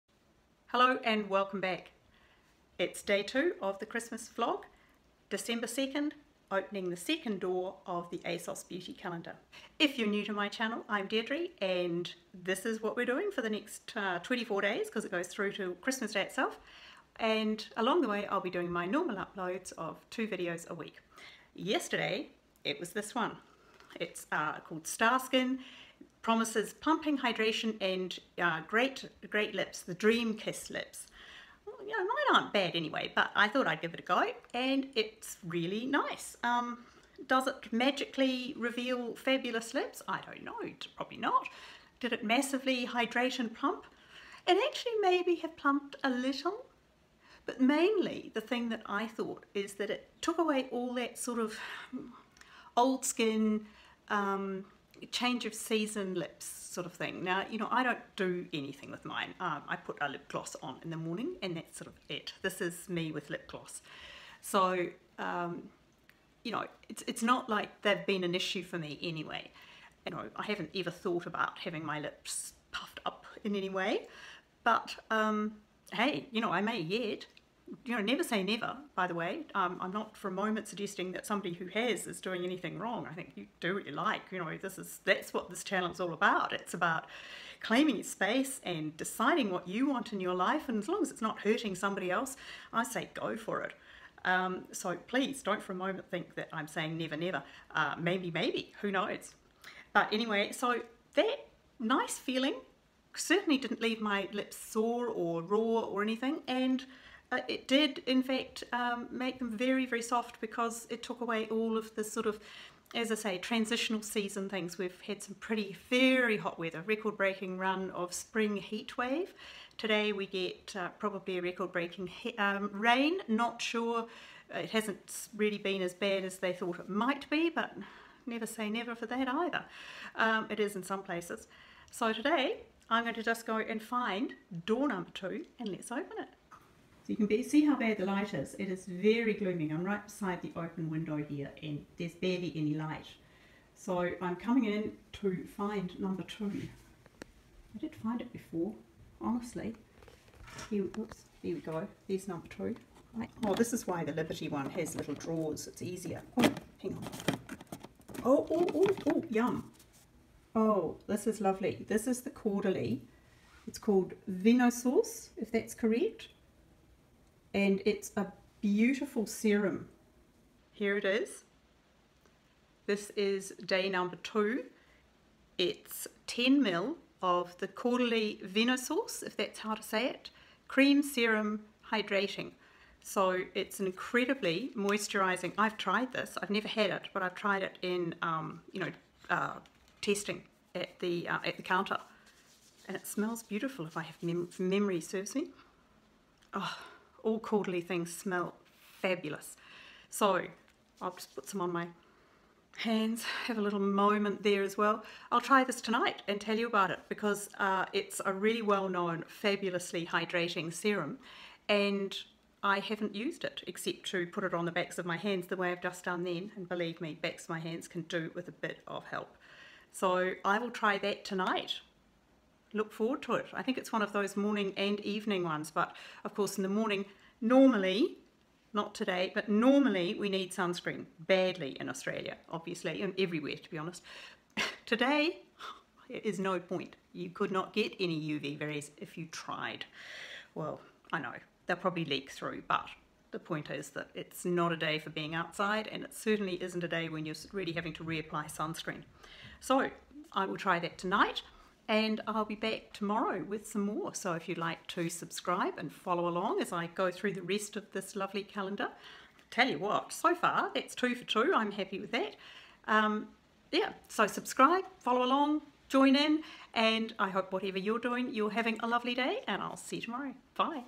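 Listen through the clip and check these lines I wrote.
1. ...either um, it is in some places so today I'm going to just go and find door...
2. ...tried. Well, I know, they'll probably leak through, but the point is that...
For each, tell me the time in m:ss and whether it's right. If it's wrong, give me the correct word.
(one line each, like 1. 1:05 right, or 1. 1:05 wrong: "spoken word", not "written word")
1. 2:09 right
2. 3:59 right.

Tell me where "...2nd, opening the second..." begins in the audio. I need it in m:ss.
0:05.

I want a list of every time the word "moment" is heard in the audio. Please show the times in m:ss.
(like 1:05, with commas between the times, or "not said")
1:20, 1:35, 3:23.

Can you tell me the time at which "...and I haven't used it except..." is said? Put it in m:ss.
3:31.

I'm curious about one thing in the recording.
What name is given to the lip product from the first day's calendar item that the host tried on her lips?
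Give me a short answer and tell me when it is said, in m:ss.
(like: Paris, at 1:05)
Dream Kiss, at 0:29.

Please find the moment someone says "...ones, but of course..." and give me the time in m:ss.
3:45.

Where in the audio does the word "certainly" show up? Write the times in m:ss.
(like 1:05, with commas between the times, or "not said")
1:43, 4:06.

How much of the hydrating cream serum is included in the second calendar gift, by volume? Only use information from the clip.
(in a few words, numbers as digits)
10 ml.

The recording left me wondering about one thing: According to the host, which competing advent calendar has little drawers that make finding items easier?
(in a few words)
Liberty.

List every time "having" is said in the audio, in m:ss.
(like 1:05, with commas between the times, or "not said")
1:11, 4:07, 4:28.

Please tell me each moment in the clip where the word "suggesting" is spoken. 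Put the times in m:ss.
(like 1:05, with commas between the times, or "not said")
1:20.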